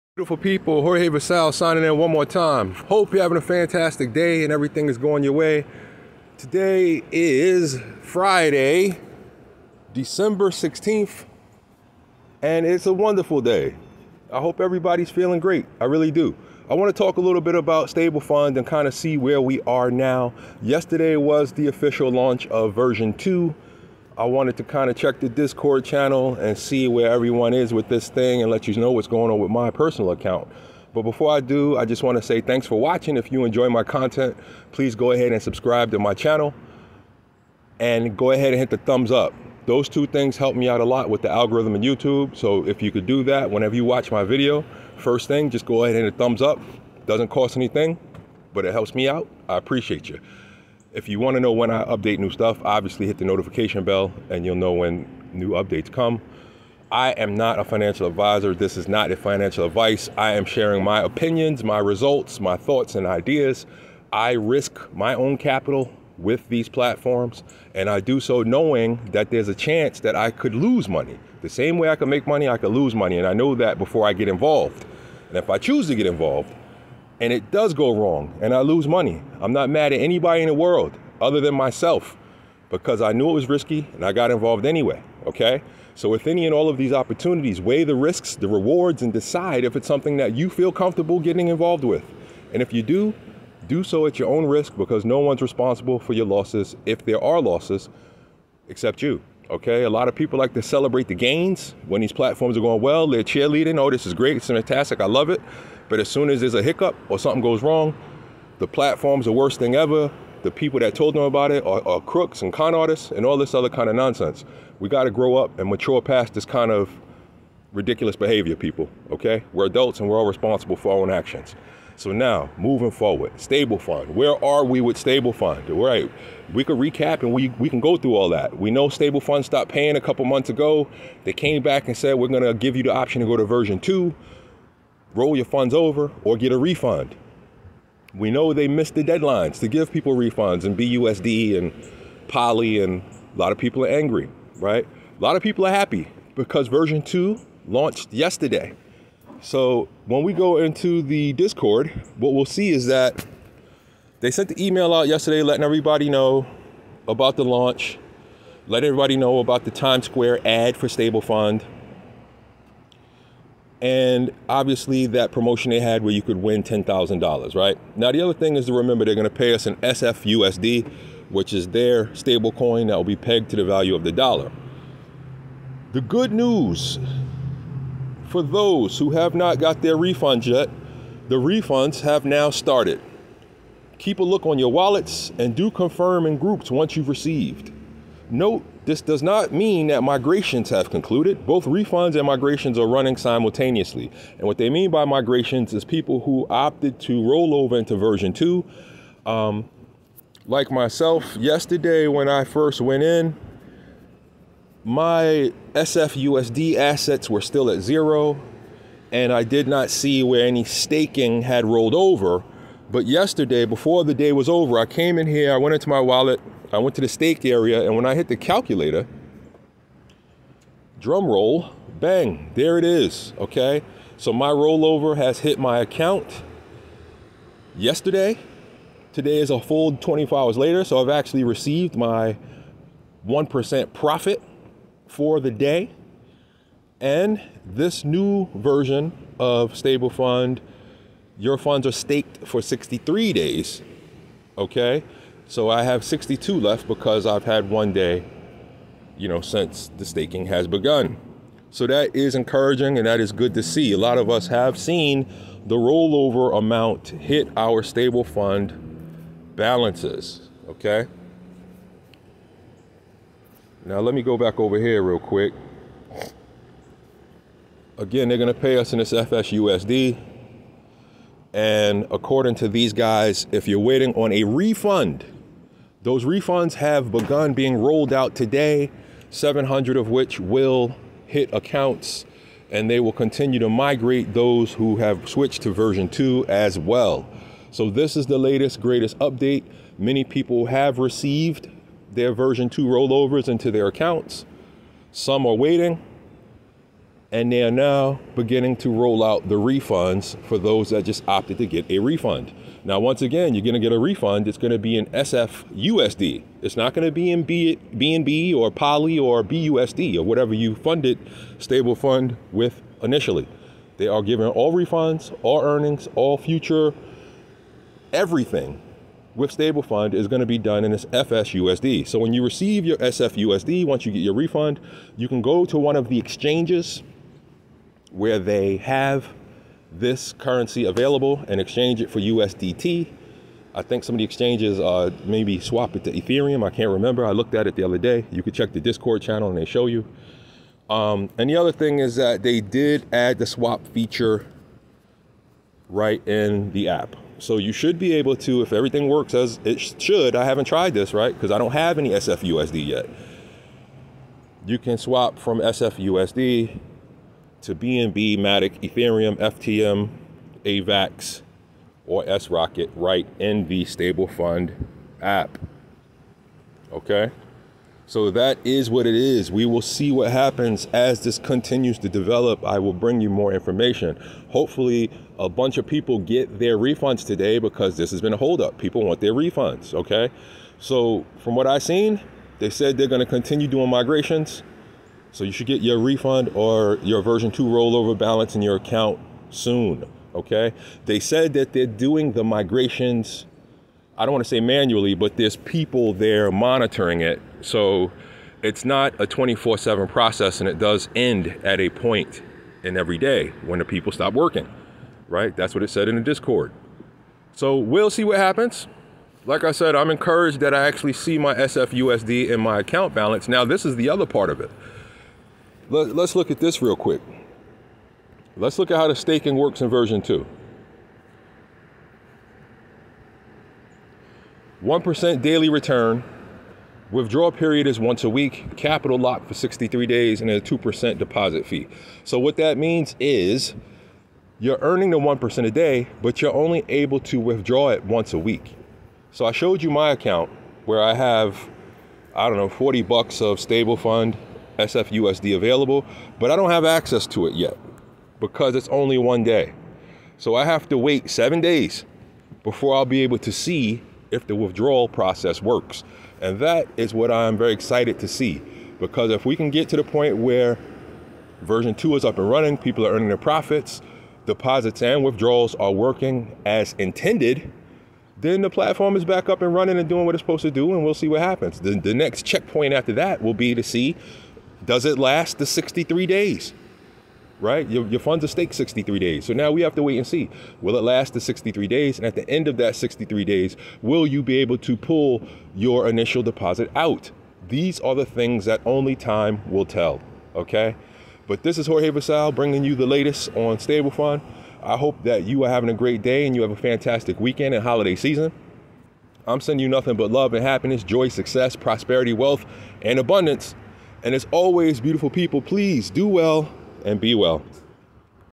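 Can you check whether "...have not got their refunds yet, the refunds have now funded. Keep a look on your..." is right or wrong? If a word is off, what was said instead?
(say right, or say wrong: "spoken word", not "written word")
wrong: "started", not "funded".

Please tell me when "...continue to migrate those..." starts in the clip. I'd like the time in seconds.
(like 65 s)
283 s.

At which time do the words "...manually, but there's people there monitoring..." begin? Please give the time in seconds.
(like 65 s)
394 s.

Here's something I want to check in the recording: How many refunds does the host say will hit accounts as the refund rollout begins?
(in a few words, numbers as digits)
700.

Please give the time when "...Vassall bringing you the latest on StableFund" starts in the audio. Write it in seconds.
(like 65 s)
492 s.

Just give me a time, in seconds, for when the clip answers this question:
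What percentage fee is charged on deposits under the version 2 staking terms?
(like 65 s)
430 s.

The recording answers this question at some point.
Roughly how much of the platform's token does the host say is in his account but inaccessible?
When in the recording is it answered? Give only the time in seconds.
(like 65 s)
442 s.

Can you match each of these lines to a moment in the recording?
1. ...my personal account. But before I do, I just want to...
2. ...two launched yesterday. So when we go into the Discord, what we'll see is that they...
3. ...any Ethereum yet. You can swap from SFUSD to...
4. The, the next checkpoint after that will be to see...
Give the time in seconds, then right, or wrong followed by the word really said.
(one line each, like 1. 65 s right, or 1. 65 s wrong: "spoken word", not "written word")
1. 29 s right
2. 147 s right
3. 351 s wrong: "SFUSD", not "Ethereum"
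4. 471 s right.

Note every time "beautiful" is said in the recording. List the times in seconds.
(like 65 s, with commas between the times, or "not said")
0 s, 505 s.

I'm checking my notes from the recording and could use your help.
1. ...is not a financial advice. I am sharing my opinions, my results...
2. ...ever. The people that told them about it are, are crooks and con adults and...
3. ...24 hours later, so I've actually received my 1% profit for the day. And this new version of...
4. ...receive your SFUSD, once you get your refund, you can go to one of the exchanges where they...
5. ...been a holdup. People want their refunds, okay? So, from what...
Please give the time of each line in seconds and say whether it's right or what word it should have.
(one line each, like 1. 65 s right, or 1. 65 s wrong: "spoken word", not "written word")
1. 58 s right
2. 109 s wrong: "artists", not "adults"
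3. 229 s right
4. 322 s right
5. 378 s right.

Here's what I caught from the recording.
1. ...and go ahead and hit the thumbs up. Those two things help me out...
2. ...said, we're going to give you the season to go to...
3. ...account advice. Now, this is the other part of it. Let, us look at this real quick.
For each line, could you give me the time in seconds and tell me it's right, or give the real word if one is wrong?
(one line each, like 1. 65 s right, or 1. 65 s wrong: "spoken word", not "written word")
1. 37 s right
2. 131 s wrong: "option", not "season"
3. 412 s wrong: "balance", not "advice".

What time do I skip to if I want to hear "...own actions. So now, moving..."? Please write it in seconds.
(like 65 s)
121 s.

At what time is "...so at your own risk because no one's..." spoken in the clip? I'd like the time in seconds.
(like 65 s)
93 s.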